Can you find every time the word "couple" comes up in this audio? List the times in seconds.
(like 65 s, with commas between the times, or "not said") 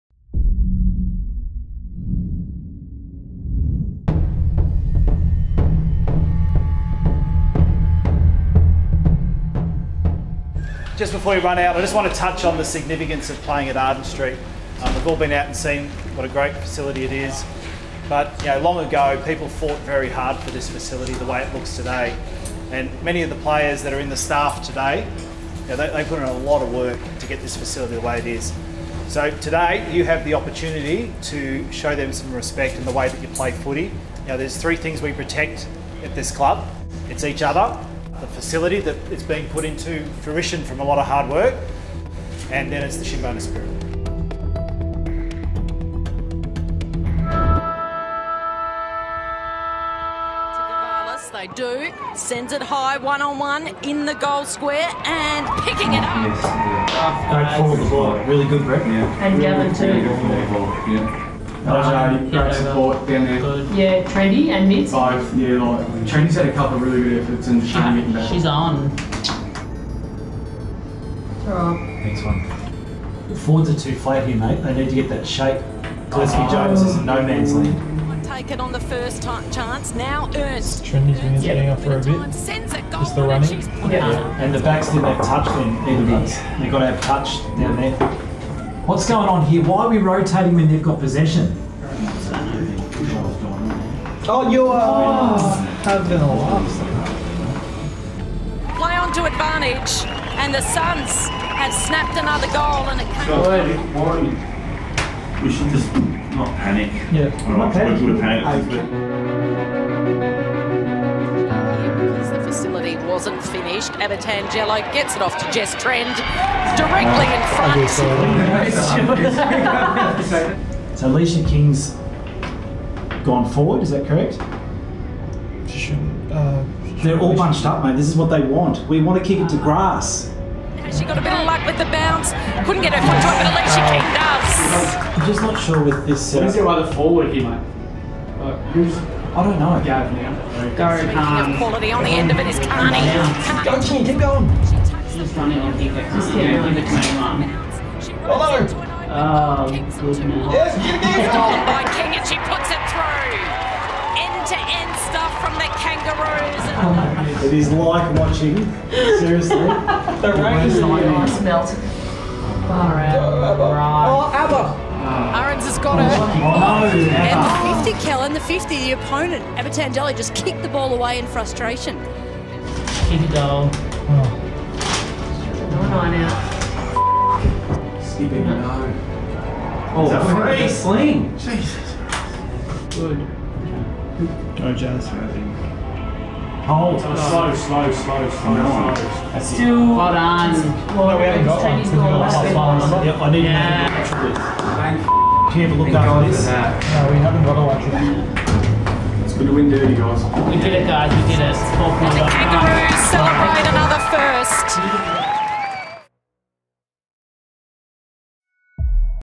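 66 s.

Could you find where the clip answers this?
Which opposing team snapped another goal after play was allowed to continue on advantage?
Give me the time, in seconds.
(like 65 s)
100 s.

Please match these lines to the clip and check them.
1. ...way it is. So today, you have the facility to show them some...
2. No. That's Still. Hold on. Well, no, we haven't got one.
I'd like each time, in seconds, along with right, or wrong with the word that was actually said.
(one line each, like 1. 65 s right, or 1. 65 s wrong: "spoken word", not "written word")
1. 28 s wrong: "opportunity", not "facility"
2. 188 s right.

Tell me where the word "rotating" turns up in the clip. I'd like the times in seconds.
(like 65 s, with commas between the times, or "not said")
89 s.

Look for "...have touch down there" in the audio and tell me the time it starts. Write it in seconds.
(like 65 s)
86 s.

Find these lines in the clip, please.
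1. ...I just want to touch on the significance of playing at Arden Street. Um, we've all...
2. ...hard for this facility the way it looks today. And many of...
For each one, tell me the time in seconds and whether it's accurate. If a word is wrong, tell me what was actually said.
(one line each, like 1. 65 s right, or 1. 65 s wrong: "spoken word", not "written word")
1. 11 s right
2. 20 s right.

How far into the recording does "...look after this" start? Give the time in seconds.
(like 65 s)
195 s.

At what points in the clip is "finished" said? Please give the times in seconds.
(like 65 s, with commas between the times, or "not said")
113 s.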